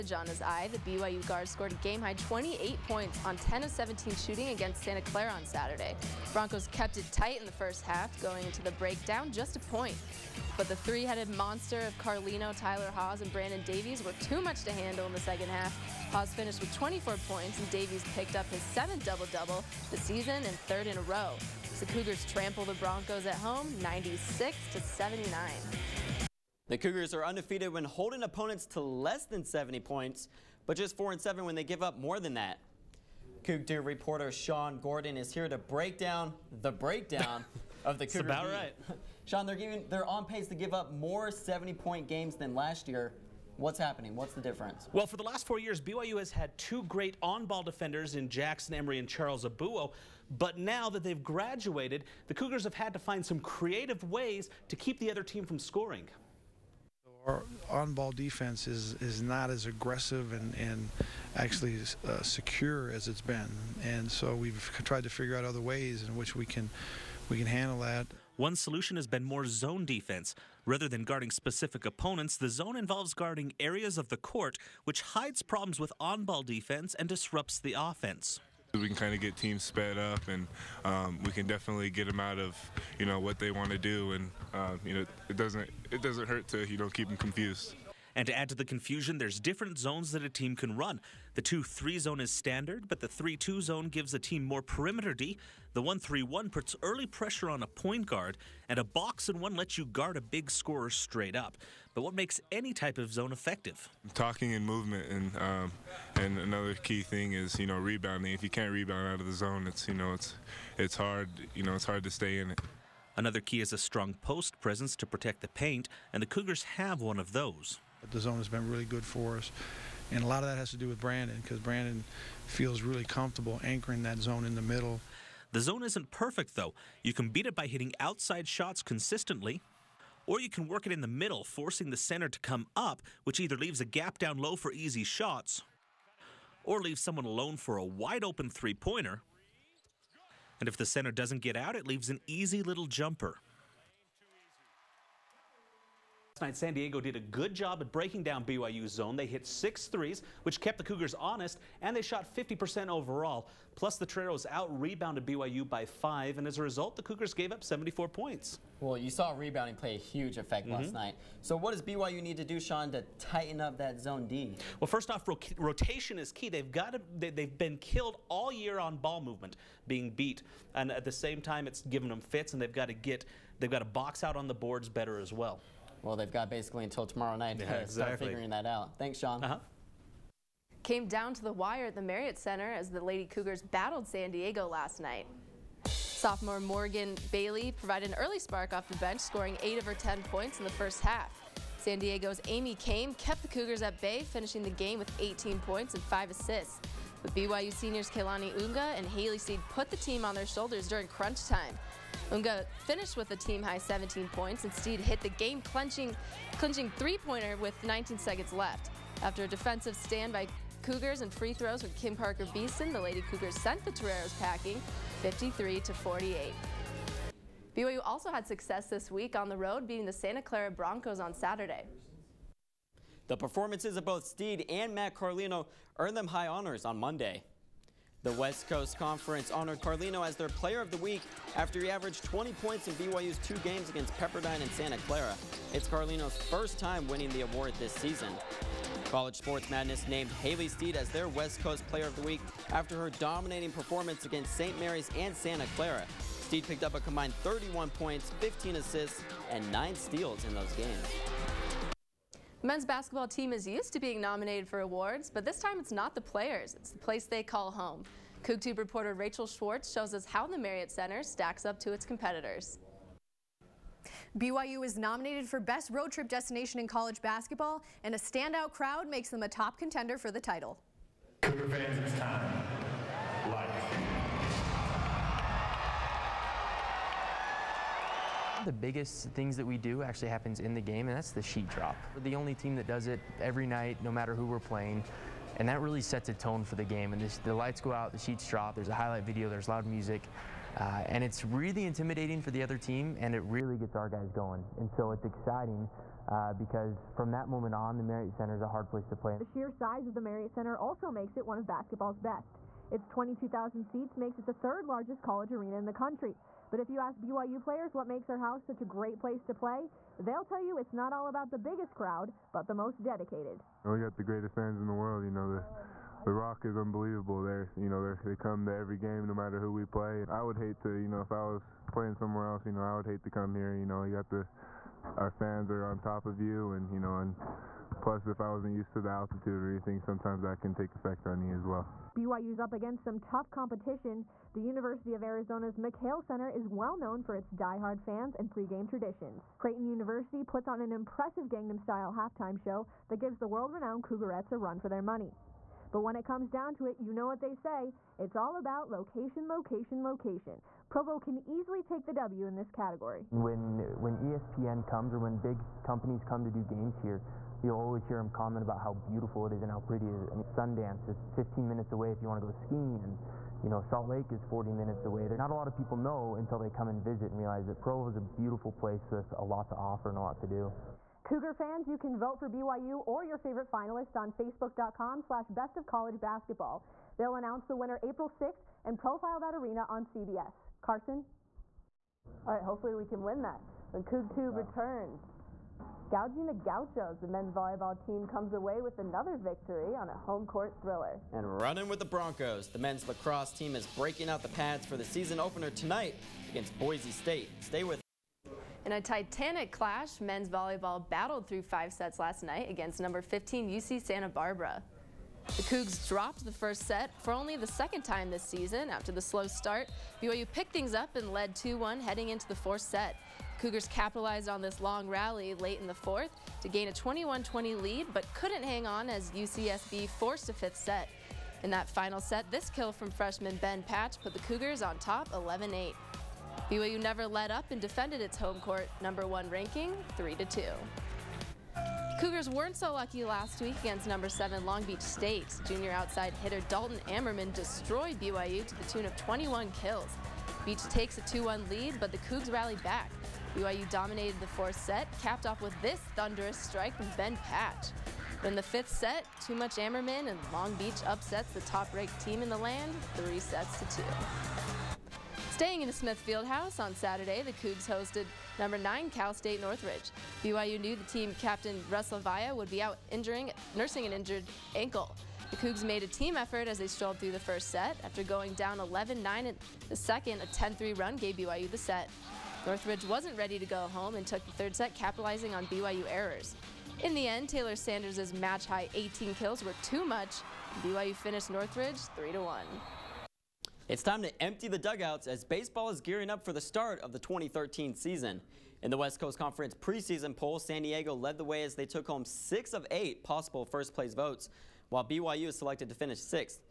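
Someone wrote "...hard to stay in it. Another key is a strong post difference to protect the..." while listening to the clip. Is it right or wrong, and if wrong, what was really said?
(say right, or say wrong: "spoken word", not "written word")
wrong: "presence", not "difference".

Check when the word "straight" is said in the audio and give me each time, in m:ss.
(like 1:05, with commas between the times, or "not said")
1:40.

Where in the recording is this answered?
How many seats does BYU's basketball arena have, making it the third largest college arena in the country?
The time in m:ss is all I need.
5:03.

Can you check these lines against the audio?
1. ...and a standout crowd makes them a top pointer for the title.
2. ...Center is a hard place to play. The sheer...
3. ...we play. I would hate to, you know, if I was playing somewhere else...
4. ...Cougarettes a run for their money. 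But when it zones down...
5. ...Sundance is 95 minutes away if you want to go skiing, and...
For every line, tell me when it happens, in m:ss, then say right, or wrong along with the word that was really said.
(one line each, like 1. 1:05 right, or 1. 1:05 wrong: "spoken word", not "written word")
1. 4:28 wrong: "contender", not "pointer"
2. 4:58 right
3. 5:19 right
4. 5:44 wrong: "comes", not "zones"
5. 6:00 wrong: "15", not "95".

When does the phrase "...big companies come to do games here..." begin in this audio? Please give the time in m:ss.
5:55.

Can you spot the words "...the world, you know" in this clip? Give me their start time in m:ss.
5:14.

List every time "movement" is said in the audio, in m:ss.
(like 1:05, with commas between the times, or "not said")
1:44, 2:49.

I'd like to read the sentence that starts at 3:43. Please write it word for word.
The performances of both Steed and Matt Carlino earned them high honors on Monday.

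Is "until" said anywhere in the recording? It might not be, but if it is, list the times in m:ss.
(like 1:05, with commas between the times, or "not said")
2:56, 6:06.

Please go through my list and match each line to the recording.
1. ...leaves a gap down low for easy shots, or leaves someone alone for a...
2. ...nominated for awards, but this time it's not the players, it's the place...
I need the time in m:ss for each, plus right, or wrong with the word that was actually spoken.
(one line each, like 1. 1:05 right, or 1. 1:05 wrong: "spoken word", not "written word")
1. 2:13 right
2. 4:14 right.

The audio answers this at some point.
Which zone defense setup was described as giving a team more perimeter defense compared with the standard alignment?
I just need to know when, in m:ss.
1:33.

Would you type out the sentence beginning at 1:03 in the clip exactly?
And so we've tried to figure out other ways in which we can we can handle that.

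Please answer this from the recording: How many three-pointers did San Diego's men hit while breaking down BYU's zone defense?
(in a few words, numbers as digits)
6.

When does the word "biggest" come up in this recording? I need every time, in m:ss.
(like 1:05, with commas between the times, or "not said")
4:38, 5:11.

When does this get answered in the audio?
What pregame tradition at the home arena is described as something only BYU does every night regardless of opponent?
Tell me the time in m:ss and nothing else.
4:41.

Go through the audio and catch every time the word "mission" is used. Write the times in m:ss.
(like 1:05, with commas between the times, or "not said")
not said.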